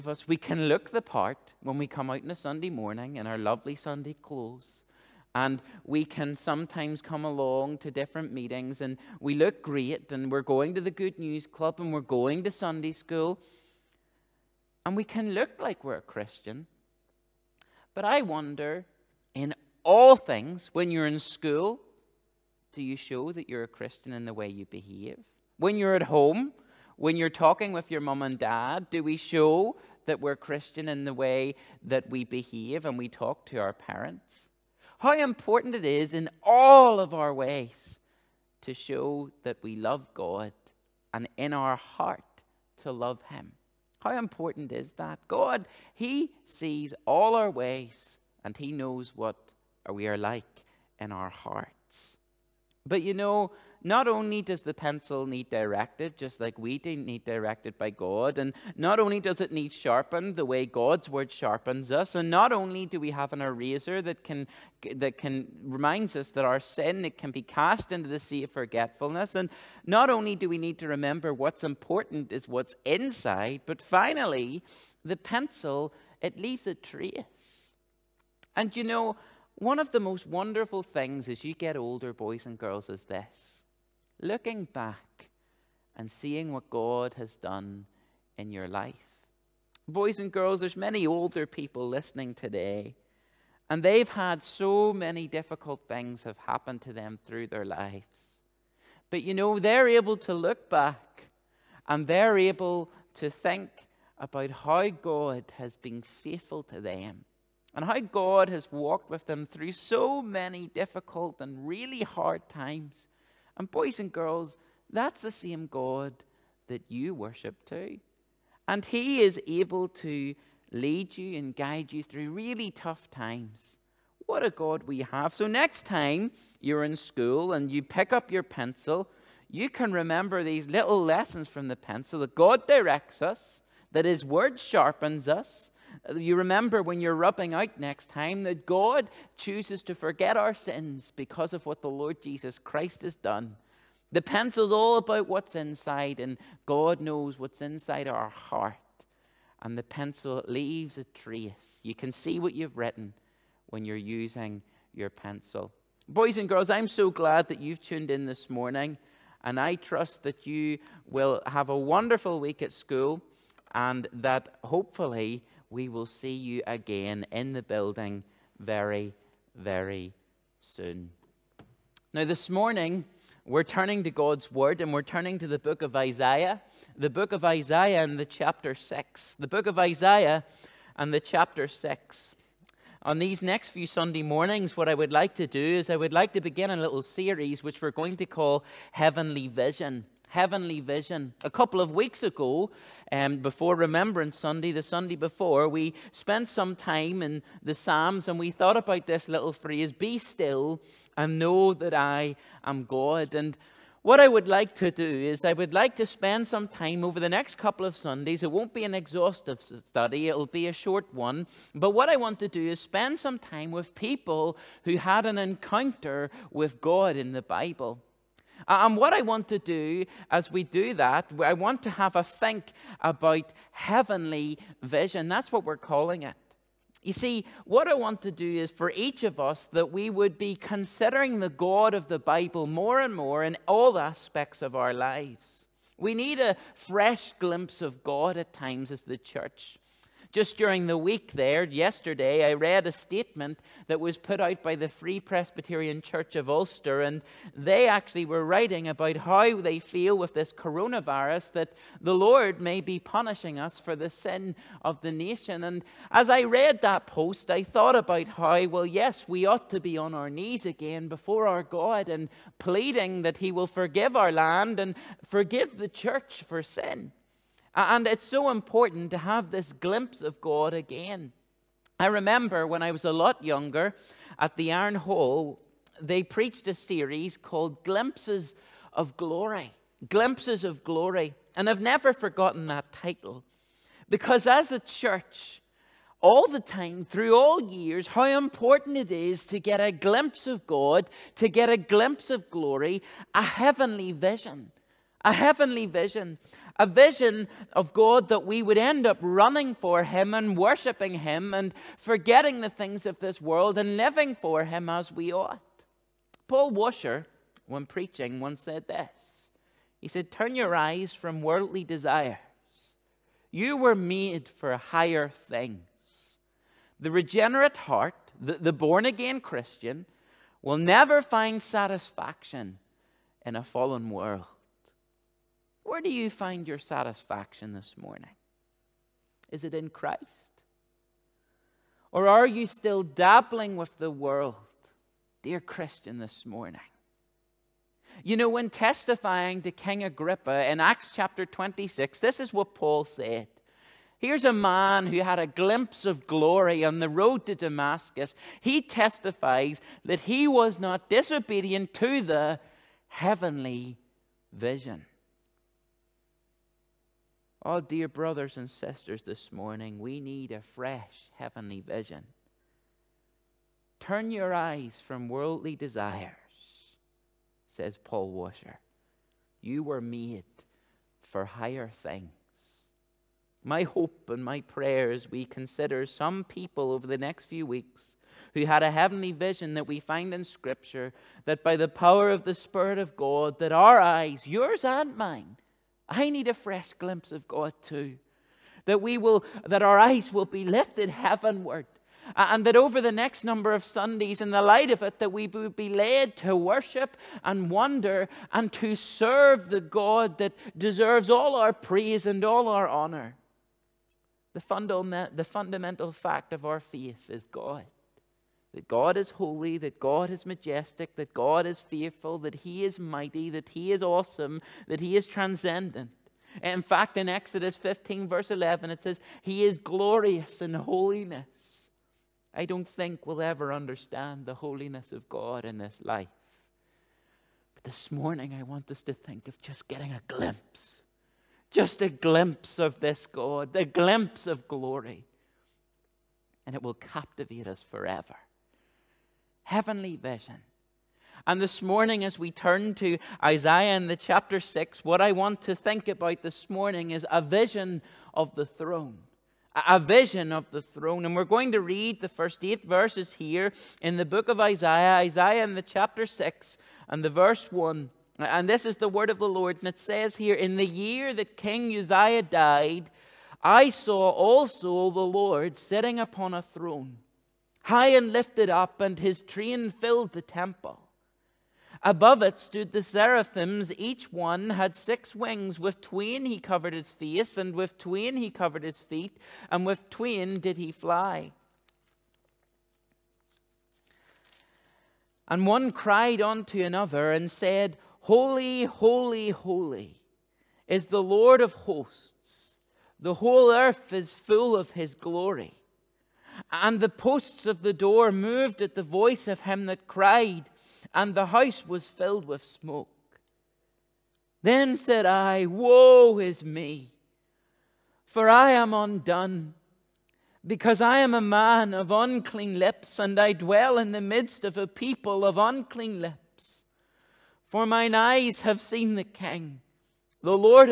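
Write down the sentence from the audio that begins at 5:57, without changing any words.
Oh, dear brothers and sisters, this morning we need a fresh heavenly vision.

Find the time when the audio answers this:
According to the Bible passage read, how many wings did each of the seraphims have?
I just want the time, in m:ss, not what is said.
7:54.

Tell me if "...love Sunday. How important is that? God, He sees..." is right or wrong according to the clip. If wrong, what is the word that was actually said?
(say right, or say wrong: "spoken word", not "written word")
wrong: "Him", not "Sunday".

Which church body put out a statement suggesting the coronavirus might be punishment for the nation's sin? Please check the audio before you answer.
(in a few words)
Free Presbyterian Church of Ulster.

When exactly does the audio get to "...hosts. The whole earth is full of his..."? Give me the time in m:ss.
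8:11.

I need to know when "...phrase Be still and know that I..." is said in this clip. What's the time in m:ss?
3:19.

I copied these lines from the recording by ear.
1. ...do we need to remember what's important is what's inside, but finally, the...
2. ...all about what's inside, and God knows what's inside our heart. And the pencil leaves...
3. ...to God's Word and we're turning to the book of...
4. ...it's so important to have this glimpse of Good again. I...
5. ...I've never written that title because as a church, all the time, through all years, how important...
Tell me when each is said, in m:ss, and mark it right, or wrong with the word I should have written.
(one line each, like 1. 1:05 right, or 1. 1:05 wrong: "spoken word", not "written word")
1. 1:10 right
2. 2:24 right
3. 2:54 right
4. 4:28 wrong: "God", not "Good"
5. 4:41 wrong: "forgotten", not "written".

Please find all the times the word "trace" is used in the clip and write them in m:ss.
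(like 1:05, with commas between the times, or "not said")
1:16, 2:31.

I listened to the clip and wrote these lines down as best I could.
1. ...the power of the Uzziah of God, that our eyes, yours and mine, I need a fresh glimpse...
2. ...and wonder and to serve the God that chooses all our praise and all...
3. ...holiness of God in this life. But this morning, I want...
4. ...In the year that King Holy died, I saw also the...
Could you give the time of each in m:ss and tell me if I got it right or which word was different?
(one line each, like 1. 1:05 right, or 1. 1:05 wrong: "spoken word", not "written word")
1. 6:21 wrong: "Spirit", not "Uzziah"
2. 6:37 wrong: "deserves", not "chooses"
3. 7:04 right
4. 7:40 wrong: "Uzziah", not "Holy".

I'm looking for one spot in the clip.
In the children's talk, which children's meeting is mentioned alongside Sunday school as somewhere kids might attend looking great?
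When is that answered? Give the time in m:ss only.
0:10.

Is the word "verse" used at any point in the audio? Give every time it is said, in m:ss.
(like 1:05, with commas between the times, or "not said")
6:58, 7:32, 7:37.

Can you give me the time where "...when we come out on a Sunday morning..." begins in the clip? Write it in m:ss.
0:01.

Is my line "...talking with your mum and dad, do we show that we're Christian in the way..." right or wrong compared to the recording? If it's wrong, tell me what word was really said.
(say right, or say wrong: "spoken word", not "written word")
right.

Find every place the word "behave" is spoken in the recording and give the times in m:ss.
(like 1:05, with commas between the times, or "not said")
0:24, 0:32.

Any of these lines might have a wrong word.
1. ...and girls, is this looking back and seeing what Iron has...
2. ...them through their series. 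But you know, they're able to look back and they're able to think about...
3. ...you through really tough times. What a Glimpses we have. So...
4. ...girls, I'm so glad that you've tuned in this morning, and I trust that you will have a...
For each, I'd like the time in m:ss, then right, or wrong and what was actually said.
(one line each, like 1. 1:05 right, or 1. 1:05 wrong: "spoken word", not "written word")
1. 1:22 wrong: "God", not "Iron"
2. 1:36 wrong: "lives", not "series"
3. 2:01 wrong: "God", not "Glimpses"
4. 2:36 right.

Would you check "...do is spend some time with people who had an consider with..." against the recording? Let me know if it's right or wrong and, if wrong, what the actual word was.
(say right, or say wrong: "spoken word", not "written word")
wrong: "encounter", not "consider".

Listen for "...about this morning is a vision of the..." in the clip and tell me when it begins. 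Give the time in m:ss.
7:26.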